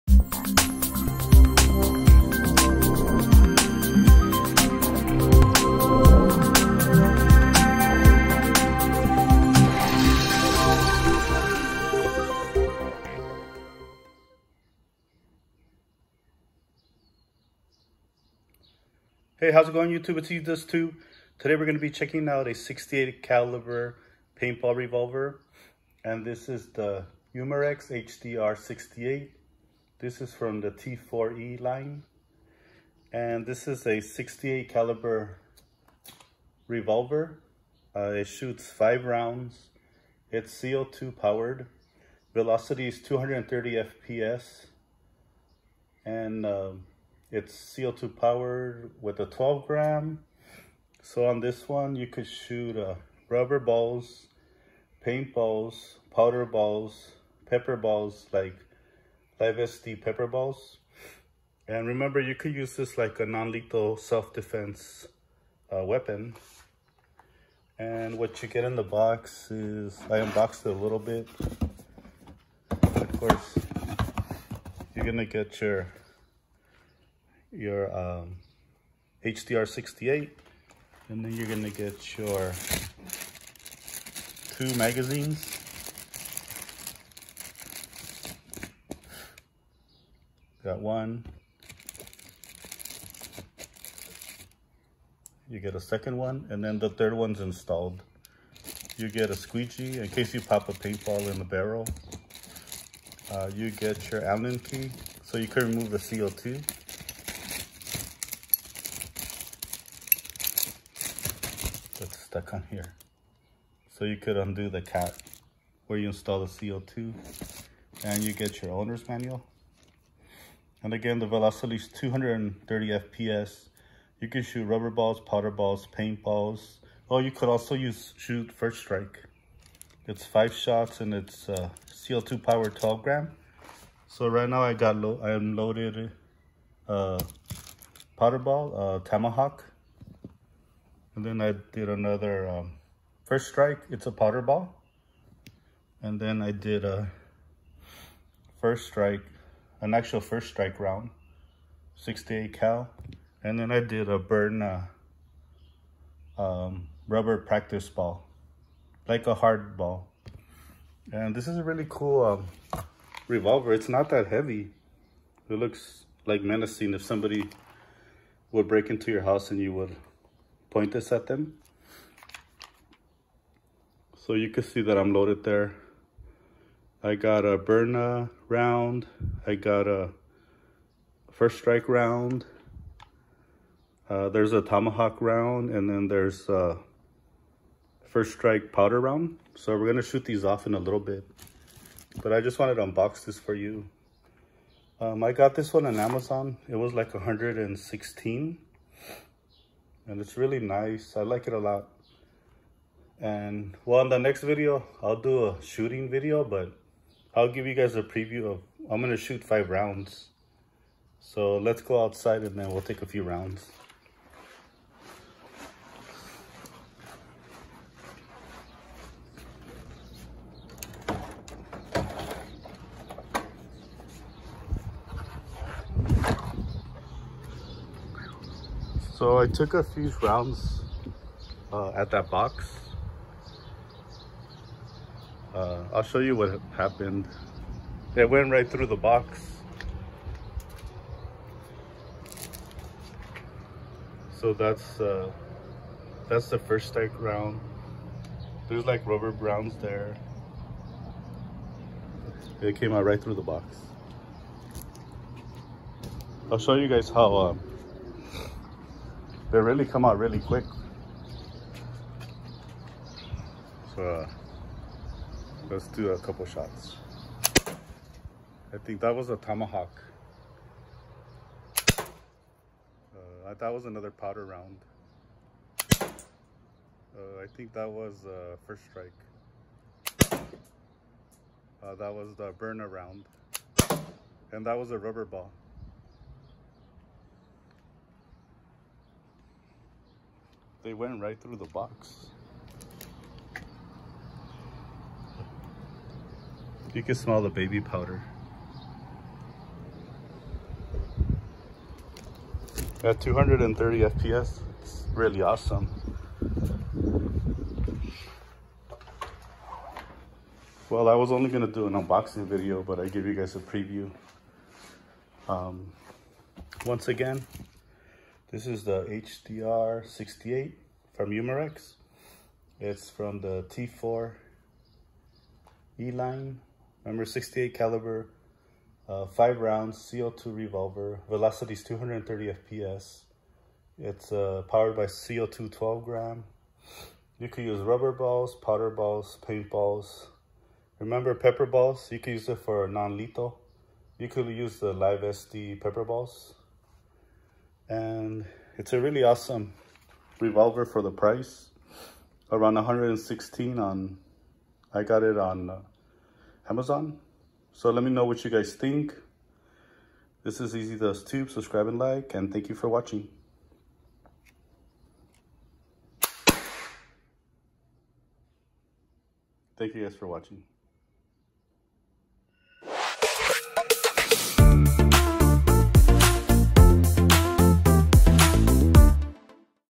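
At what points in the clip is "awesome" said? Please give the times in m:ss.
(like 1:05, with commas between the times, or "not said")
5:05, 5:49.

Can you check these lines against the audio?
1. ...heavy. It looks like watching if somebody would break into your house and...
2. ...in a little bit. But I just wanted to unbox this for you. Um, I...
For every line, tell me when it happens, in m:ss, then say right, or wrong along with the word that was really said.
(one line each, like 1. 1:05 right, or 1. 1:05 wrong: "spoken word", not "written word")
1. 2:44 wrong: "menacing", not "watching"
2. 3:10 right.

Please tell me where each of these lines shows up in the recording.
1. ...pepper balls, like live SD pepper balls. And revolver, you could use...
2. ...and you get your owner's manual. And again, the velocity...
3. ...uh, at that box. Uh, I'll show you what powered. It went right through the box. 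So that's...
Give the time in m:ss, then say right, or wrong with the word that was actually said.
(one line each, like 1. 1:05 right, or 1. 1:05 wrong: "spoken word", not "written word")
1. 0:57 wrong: "remember", not "revolver"
2. 1:58 right
3. 3:51 wrong: "happened", not "powered".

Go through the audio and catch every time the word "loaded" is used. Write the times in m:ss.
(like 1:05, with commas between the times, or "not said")
2:15, 2:55.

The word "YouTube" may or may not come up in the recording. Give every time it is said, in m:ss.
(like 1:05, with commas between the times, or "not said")
0:19.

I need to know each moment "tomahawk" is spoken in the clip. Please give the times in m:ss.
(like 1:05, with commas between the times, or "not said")
2:19, 3:04, 4:29.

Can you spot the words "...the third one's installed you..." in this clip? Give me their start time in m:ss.
1:36.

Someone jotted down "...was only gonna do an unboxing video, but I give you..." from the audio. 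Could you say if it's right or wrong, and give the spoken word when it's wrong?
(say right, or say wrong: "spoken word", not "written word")
right.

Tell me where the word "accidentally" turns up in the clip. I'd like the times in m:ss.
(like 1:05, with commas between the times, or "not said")
not said.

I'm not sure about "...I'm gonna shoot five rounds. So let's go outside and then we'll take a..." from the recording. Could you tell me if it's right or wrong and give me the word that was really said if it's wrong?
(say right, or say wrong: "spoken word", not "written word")
right.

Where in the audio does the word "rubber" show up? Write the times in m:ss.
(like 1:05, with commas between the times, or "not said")
0:53, 2:04, 2:37, 4:09, 4:44, 5:37.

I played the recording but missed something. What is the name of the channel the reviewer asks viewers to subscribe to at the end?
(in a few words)
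Ezduztube.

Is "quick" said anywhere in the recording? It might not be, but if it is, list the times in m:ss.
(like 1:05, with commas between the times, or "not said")
4:20.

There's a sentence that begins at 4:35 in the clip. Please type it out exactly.
Uh, I think that was uh, first strike.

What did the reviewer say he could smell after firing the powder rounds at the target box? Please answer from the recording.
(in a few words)
baby powder.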